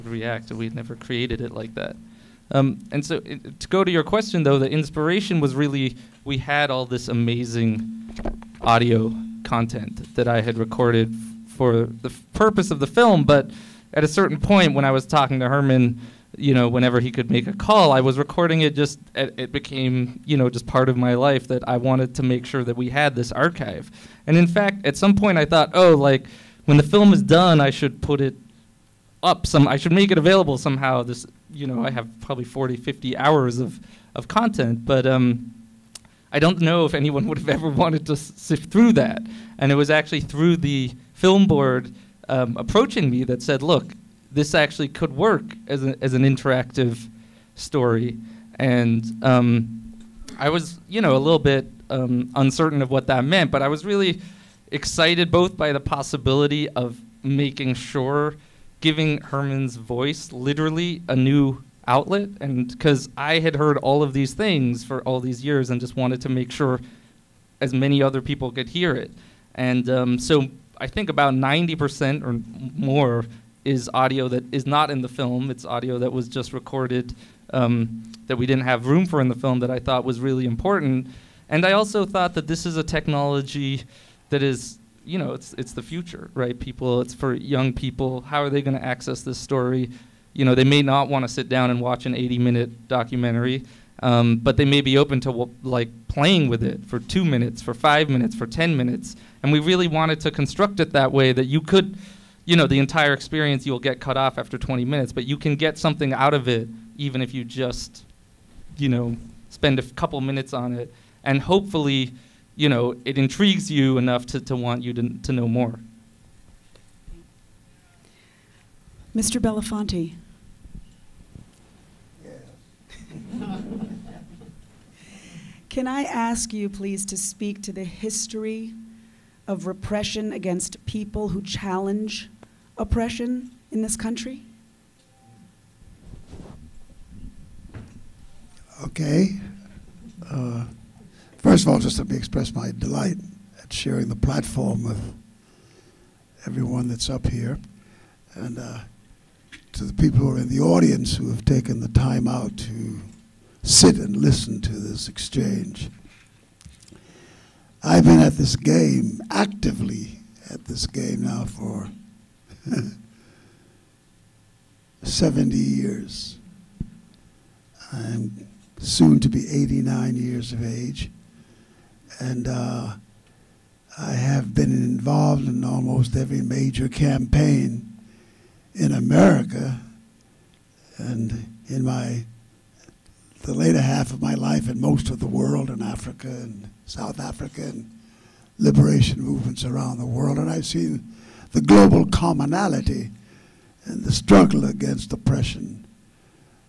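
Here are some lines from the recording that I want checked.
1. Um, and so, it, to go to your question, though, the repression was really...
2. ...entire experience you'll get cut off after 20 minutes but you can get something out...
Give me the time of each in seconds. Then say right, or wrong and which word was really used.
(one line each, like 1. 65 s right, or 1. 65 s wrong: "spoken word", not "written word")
1. 2 s wrong: "inspiration", not "repression"
2. 102 s right.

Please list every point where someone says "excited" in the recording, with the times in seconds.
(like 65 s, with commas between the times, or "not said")
54 s.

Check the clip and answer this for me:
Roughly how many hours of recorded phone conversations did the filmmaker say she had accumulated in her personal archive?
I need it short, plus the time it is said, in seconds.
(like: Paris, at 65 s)
40 to 50 hours, at 32 s.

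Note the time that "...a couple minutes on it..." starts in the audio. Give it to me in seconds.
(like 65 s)
109 s.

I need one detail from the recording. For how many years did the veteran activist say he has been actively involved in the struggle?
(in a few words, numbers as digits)
70 years.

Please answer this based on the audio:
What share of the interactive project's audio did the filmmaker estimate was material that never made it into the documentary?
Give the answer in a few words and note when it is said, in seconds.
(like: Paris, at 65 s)
90% or more, at 71 s.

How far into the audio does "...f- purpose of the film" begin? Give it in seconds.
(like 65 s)
12 s.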